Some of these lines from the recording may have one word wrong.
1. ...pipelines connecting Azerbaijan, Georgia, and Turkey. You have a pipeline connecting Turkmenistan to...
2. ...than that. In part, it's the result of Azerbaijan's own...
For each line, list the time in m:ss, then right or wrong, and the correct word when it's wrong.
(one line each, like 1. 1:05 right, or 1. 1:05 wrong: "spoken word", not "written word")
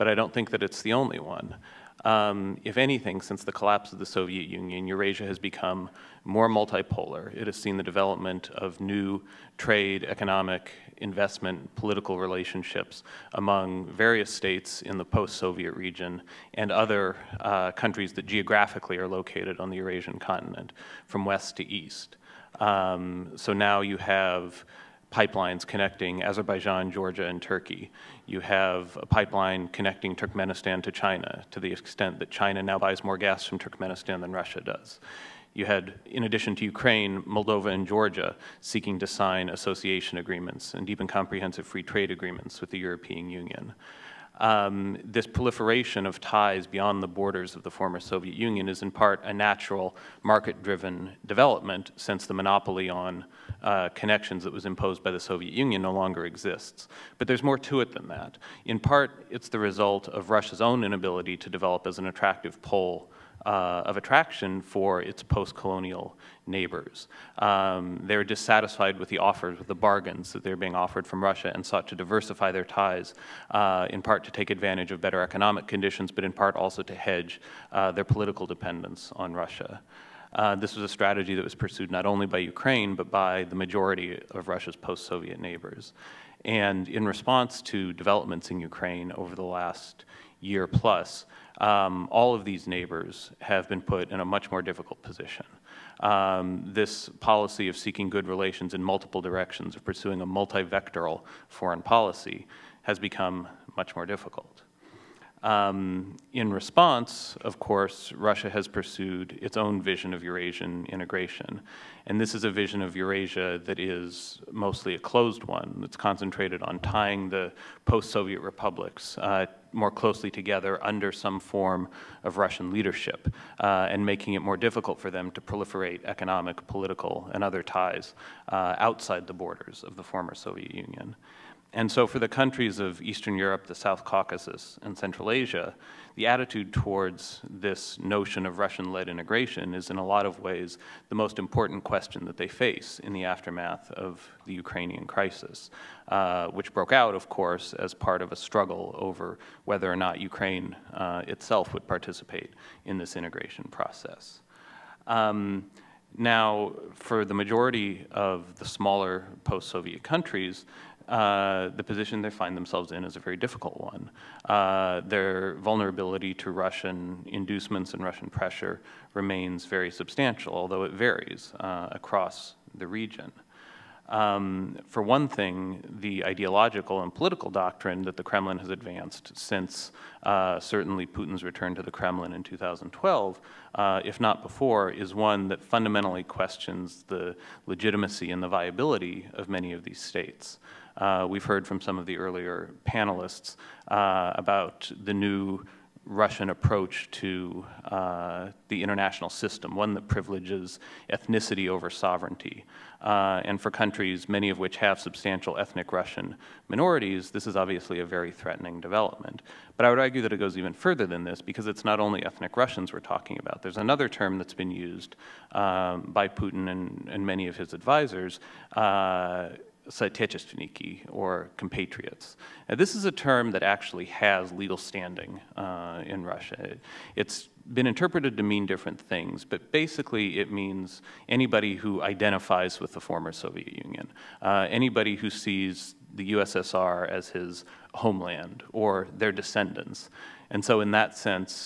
1. 0:25 right
2. 0:57 wrong: "Russia", not "Azerbaijan".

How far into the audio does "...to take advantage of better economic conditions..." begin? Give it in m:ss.
1:14.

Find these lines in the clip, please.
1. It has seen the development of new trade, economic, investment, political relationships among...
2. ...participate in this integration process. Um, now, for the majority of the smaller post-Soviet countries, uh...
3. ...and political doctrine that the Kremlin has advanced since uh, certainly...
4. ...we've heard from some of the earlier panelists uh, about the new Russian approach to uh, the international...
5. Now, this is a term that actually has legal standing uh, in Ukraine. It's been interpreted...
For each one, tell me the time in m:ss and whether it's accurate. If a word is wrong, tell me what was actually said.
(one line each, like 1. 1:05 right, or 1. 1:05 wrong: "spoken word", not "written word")
1. 0:07 right
2. 2:31 right
3. 2:57 right
4. 3:11 right
5. 3:42 wrong: "Russia", not "Ukraine".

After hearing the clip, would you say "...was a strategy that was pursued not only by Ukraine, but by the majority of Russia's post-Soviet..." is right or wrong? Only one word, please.
right.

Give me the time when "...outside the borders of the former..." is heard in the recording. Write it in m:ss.
2:08.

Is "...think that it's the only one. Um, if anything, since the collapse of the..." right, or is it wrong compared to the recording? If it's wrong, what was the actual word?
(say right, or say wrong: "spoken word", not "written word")
right.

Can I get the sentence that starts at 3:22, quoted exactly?
Uh, and for countries, many of which have substantial ethnic Russian minorities, this is obviously a very threatening development.